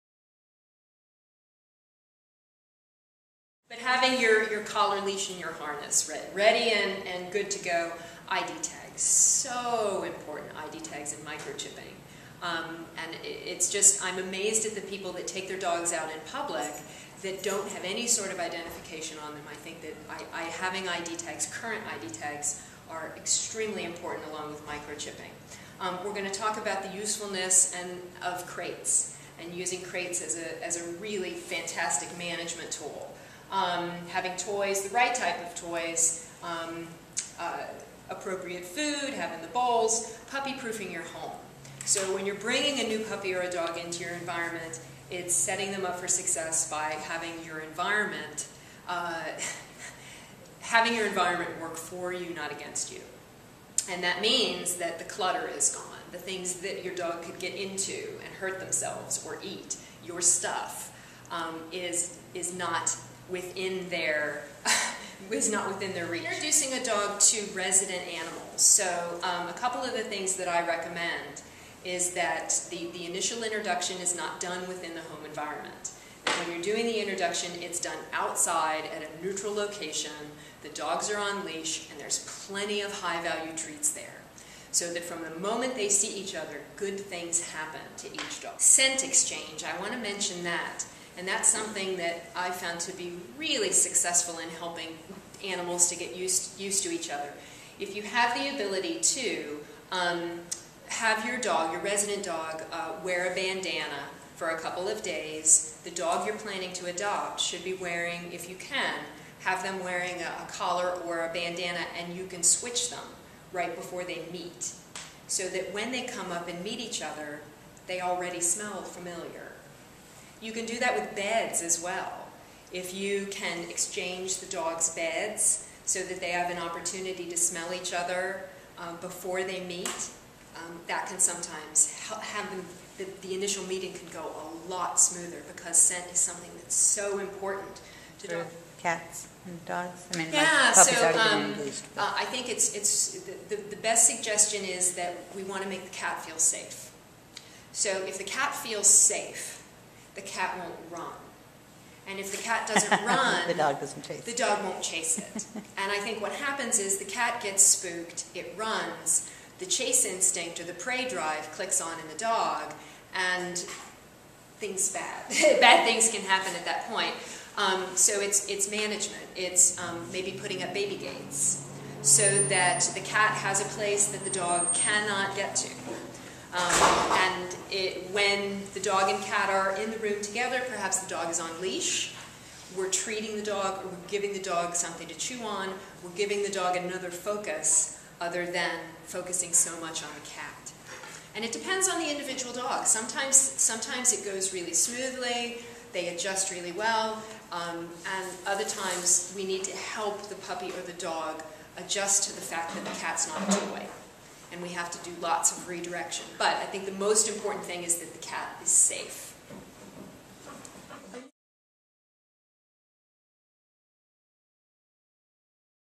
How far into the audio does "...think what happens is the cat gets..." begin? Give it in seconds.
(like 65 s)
155 s.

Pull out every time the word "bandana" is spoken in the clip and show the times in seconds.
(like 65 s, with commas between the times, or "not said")
103 s, 111 s.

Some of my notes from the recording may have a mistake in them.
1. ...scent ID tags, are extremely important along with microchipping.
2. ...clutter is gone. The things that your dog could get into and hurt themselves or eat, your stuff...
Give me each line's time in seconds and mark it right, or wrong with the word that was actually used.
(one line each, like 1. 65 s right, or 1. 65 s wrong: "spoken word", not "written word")
1. 21 s wrong: "current", not "scent"
2. 55 s right.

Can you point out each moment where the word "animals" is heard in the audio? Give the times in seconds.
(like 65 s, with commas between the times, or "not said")
68 s, 95 s.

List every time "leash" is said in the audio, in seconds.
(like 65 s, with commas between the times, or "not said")
4 s, 81 s, 181 s.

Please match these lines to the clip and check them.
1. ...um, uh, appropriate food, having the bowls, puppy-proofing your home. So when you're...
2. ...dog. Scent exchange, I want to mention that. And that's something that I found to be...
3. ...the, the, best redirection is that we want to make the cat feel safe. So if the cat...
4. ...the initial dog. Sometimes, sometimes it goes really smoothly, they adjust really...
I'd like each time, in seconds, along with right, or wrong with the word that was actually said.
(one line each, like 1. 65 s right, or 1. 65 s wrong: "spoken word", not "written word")
1. 36 s right
2. 88 s right
3. 143 s wrong: "suggestion", not "redirection"
4. 192 s wrong: "individual", not "initial".